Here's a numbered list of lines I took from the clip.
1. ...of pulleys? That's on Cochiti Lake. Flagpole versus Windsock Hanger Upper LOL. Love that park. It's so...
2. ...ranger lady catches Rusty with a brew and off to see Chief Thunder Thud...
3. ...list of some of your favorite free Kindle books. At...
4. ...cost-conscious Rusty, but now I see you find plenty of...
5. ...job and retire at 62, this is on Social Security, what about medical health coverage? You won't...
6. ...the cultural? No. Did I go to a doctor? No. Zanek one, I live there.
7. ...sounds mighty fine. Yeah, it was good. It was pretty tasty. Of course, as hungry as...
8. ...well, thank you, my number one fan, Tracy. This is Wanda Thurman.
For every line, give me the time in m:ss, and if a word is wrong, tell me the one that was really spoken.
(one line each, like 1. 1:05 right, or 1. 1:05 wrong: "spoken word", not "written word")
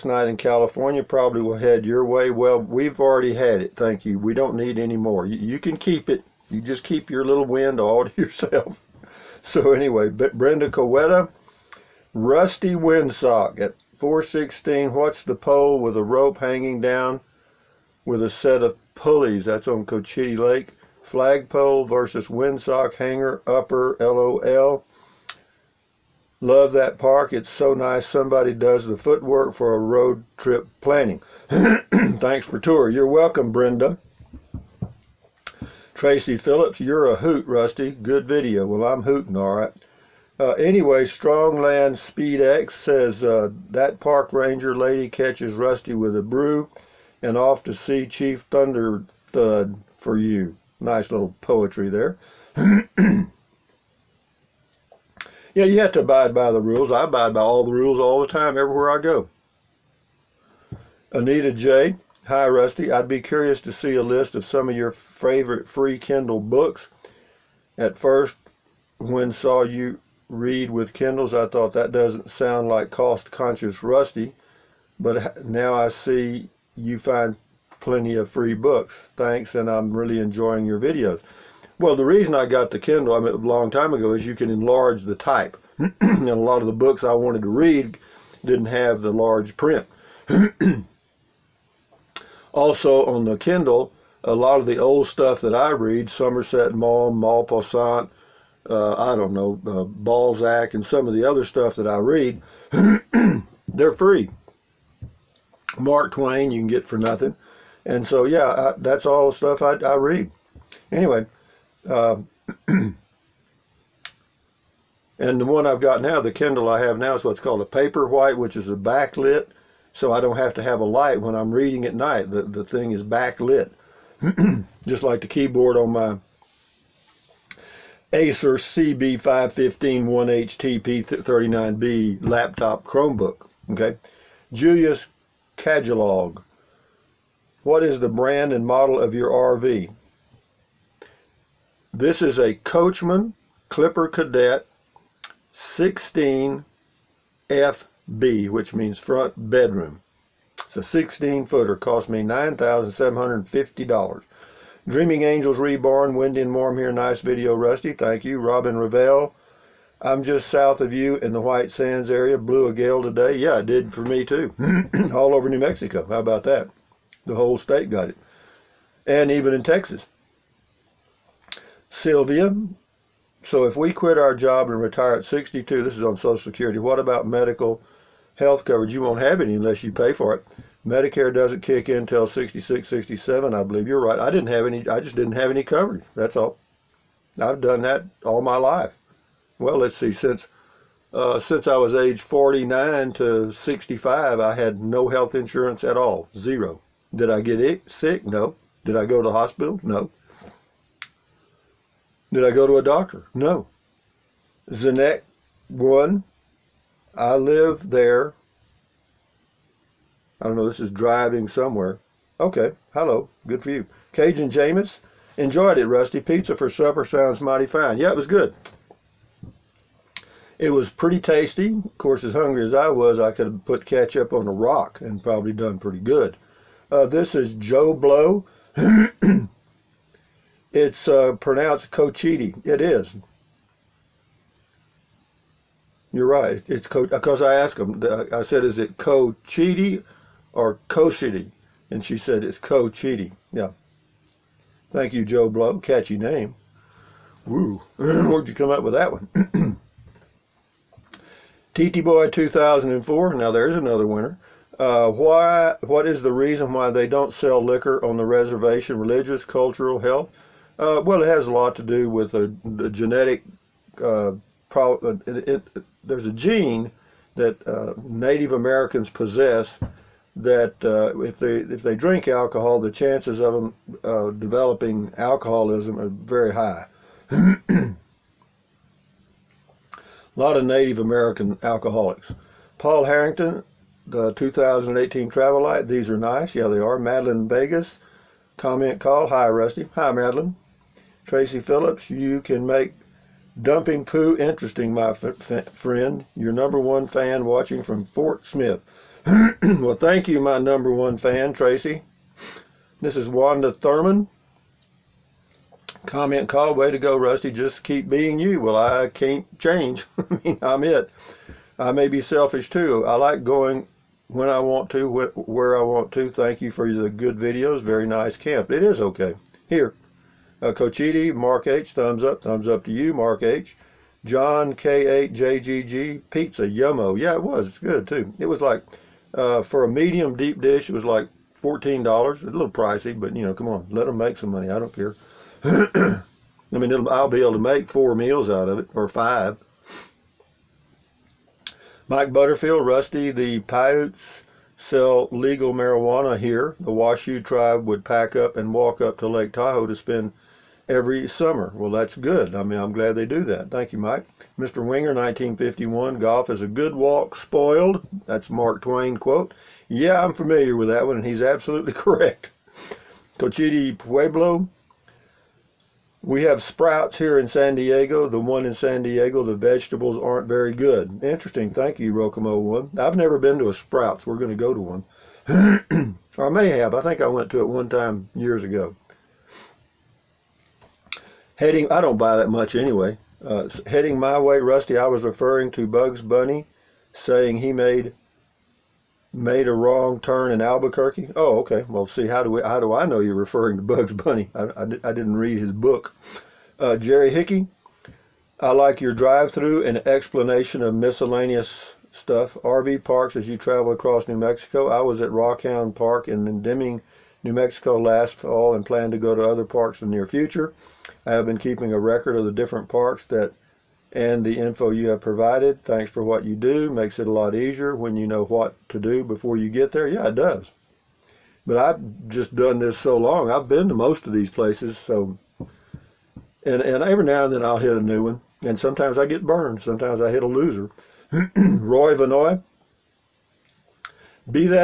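1. 0:18 right
2. 0:44 right
3. 1:04 right
4. 1:12 right
5. 2:54 right
6. 3:19 wrong: "hospital", not "cultural"
7. 3:37 right
8. 4:59 right.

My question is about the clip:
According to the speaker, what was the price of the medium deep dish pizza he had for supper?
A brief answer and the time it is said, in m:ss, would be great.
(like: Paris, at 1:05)
$14, at 5:31.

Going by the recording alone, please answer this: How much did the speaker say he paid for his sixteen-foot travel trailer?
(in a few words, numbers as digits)
$9,750.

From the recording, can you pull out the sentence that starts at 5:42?
Mike Butterfield, Rusty, the Paiutes sell legal marijuana here.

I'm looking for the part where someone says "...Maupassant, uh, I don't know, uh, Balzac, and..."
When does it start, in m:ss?
1:37.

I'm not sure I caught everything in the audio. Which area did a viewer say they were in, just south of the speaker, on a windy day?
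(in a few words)
White Sands.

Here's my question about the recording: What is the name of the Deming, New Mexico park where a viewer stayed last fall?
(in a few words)
Rockhound Park.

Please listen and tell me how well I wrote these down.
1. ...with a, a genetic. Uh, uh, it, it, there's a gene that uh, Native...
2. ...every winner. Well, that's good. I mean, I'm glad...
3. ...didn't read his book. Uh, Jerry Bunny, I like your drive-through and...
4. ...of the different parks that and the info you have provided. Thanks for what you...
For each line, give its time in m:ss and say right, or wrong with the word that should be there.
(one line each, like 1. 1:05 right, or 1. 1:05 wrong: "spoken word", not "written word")
1. 4:22 right
2. 5:50 wrong: "summer", not "winner"
3. 6:35 wrong: "Hickey", not "Bunny"
4. 6:52 right.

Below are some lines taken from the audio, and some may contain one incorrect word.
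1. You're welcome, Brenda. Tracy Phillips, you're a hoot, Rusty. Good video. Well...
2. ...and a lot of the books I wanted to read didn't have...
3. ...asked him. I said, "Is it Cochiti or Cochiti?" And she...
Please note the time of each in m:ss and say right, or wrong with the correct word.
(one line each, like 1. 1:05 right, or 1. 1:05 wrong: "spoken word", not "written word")
1. 0:32 right
2. 1:25 right
3. 3:57 right.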